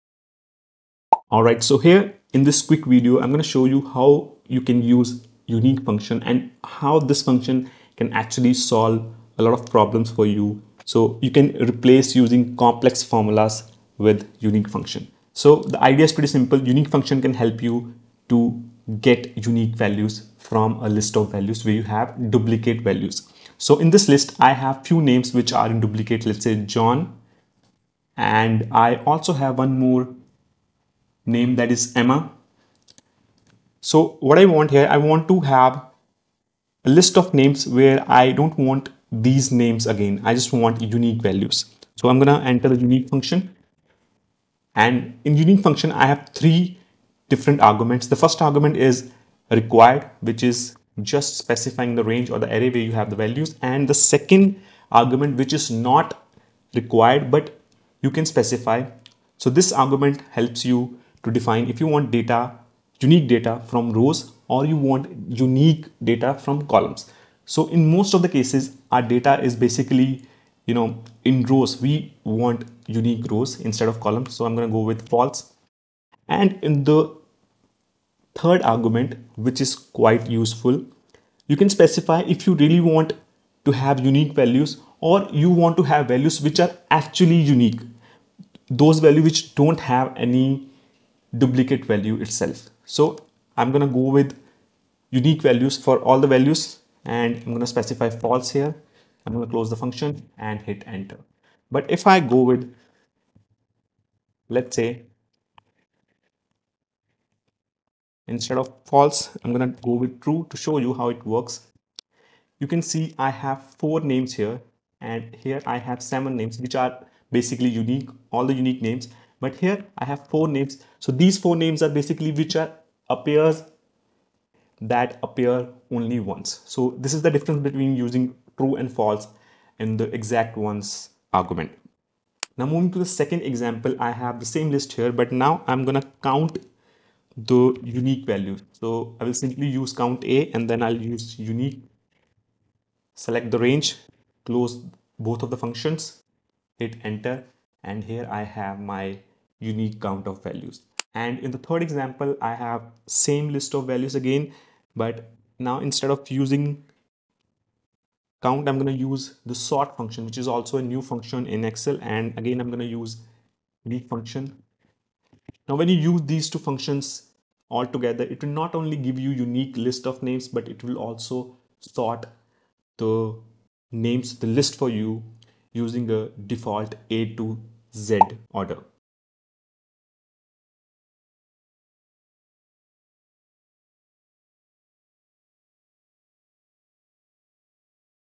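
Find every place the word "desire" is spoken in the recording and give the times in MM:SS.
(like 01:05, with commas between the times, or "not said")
not said.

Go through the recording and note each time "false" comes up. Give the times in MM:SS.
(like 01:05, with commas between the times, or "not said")
01:15, 01:38, 01:48, 02:08.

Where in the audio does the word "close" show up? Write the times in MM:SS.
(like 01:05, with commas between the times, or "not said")
01:39, 02:24.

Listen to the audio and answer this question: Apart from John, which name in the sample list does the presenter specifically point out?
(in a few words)
Emma.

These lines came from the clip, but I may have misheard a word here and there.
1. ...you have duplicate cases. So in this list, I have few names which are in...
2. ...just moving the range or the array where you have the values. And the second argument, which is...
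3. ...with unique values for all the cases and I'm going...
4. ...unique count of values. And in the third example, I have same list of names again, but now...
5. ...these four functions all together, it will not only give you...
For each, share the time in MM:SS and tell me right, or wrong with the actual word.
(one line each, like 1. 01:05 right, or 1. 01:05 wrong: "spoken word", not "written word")
1. 00:21 wrong: "values", not "cases"
2. 00:51 wrong: "specifying", not "moving"
3. 01:34 wrong: "values", not "cases"
4. 02:29 wrong: "values", not "names"
5. 02:46 wrong: "two", not "four".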